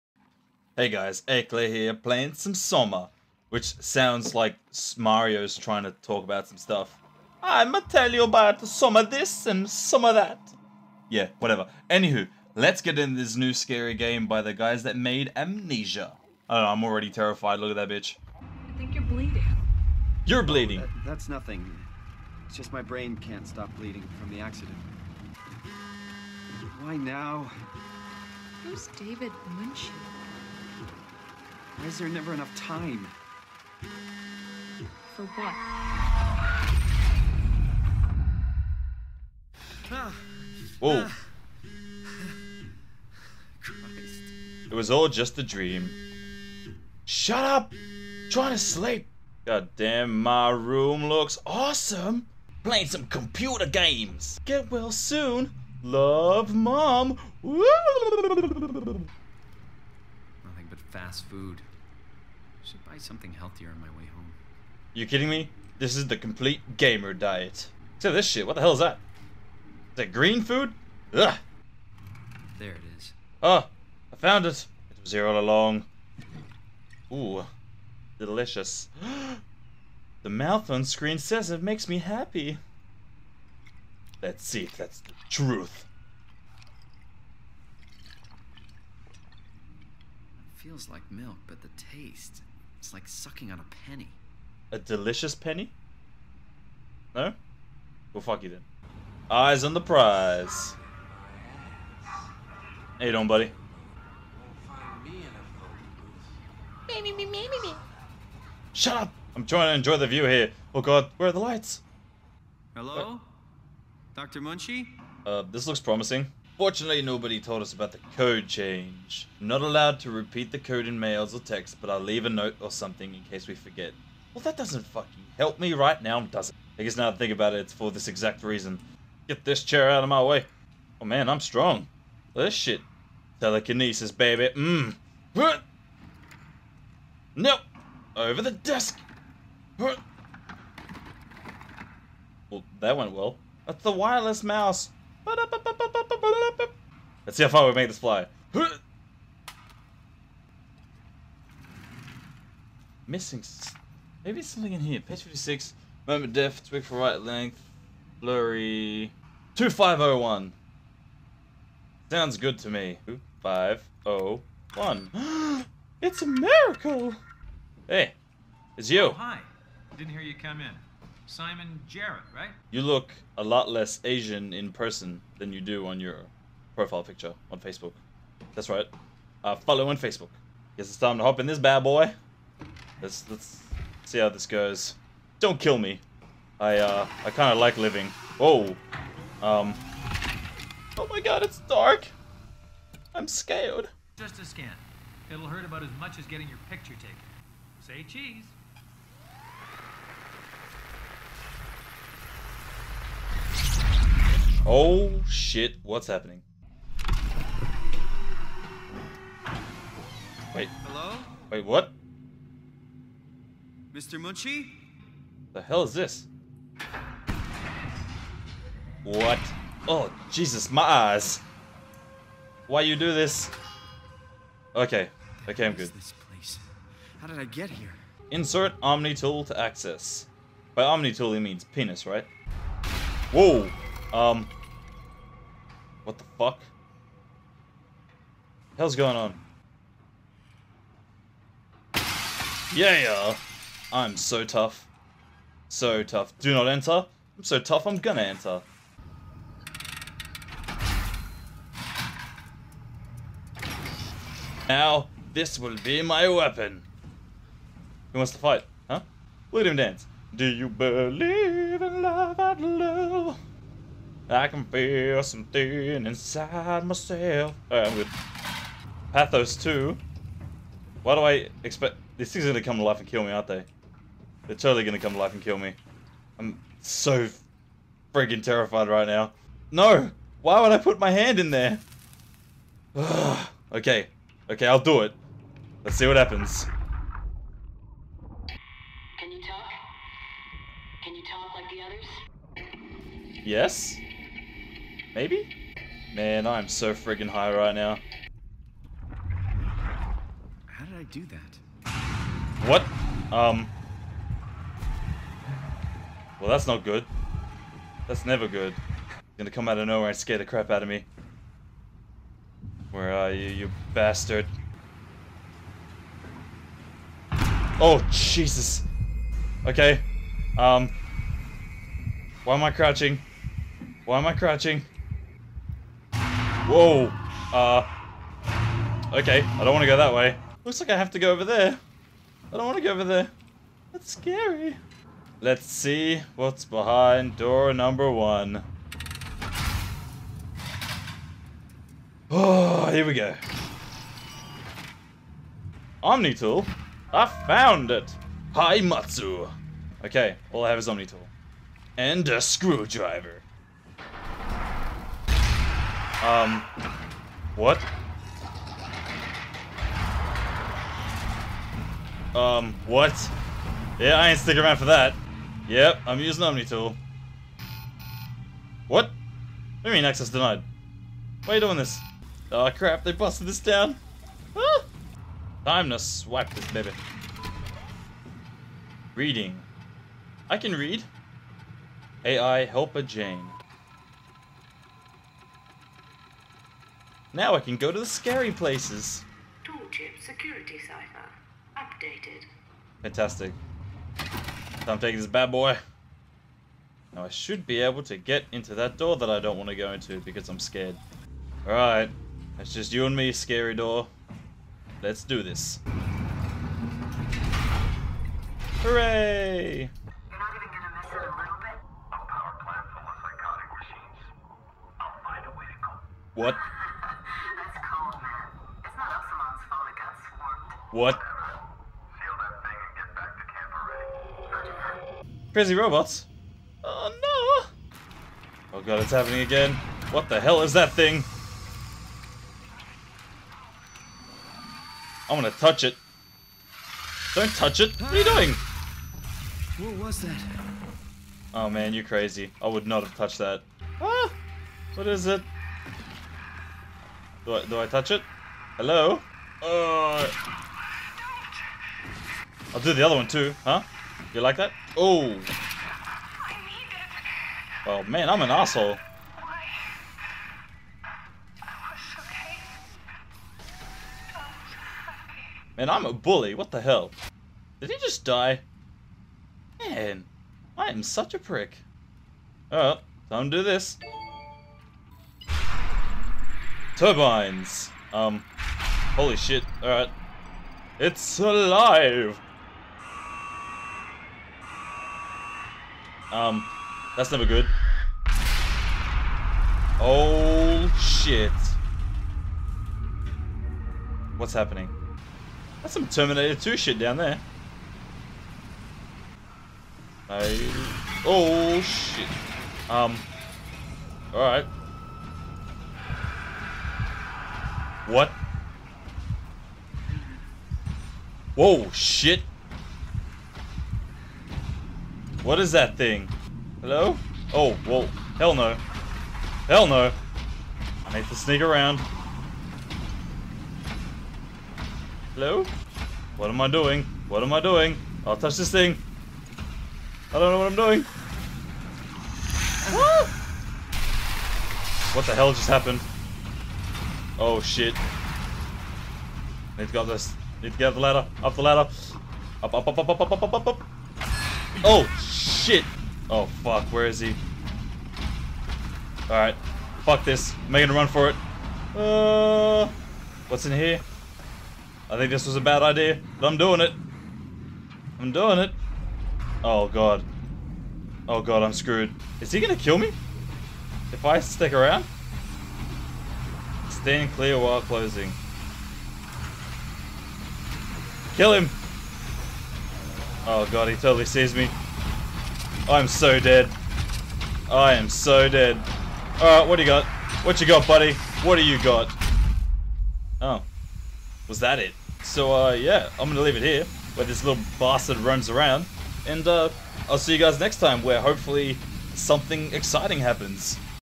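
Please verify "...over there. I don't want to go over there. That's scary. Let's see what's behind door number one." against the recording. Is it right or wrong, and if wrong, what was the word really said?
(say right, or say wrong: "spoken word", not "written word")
right.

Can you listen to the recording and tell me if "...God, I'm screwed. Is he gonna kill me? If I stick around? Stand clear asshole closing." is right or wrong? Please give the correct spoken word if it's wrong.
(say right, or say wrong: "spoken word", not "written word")
wrong: "while", not "asshole".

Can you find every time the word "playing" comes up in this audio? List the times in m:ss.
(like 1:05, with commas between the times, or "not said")
0:01, 0:52.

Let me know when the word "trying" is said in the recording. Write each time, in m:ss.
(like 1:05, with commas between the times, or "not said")
0:05, 0:48, 1:49.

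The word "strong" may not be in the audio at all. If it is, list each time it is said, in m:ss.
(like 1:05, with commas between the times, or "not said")
2:11.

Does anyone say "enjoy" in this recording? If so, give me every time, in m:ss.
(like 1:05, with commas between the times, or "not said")
1:49.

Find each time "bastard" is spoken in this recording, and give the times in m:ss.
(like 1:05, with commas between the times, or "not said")
5:13, 9:47.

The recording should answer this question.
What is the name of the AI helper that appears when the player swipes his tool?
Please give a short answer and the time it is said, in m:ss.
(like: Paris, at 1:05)
Jane, at 6:22.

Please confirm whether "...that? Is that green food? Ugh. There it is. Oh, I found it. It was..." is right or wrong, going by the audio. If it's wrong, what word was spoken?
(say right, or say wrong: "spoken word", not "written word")
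right.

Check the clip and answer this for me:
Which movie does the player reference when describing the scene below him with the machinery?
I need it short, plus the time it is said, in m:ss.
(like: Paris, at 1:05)
Terminator 2, at 8:16.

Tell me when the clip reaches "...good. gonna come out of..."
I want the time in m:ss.
5:08.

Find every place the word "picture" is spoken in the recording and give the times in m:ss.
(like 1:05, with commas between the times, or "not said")
2:57, 3:16.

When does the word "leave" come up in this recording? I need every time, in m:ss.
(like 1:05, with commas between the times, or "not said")
2:01, 9:46.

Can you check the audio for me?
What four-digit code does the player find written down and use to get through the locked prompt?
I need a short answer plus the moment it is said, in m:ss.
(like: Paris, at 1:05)
2501, at 2:39.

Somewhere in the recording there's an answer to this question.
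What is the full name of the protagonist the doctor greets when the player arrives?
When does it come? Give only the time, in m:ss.
2:51.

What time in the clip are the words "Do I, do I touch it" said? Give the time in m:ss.
7:27.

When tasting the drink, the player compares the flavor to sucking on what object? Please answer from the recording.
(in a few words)
a penny.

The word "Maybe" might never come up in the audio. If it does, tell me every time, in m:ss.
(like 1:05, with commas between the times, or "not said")
2:34, 4:55.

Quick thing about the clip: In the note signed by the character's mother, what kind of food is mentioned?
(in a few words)
fast food.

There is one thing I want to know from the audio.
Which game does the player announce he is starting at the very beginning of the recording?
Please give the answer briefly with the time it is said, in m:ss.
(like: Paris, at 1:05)
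Soma, at 0:02.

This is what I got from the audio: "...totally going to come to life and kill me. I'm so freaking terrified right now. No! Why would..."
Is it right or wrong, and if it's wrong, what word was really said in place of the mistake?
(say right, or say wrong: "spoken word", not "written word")
right.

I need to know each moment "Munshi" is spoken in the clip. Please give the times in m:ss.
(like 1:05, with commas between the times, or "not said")
0:29, 1:54, 3:34.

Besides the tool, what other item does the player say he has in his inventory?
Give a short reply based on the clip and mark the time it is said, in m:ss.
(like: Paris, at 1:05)
a screwdriver, at 5:52.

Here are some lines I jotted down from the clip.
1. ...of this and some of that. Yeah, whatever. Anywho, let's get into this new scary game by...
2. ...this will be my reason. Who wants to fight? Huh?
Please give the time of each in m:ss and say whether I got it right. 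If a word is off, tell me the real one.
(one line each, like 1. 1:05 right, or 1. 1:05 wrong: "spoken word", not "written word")
1. 0:08 right
2. 4:15 wrong: "weapon", not "reason".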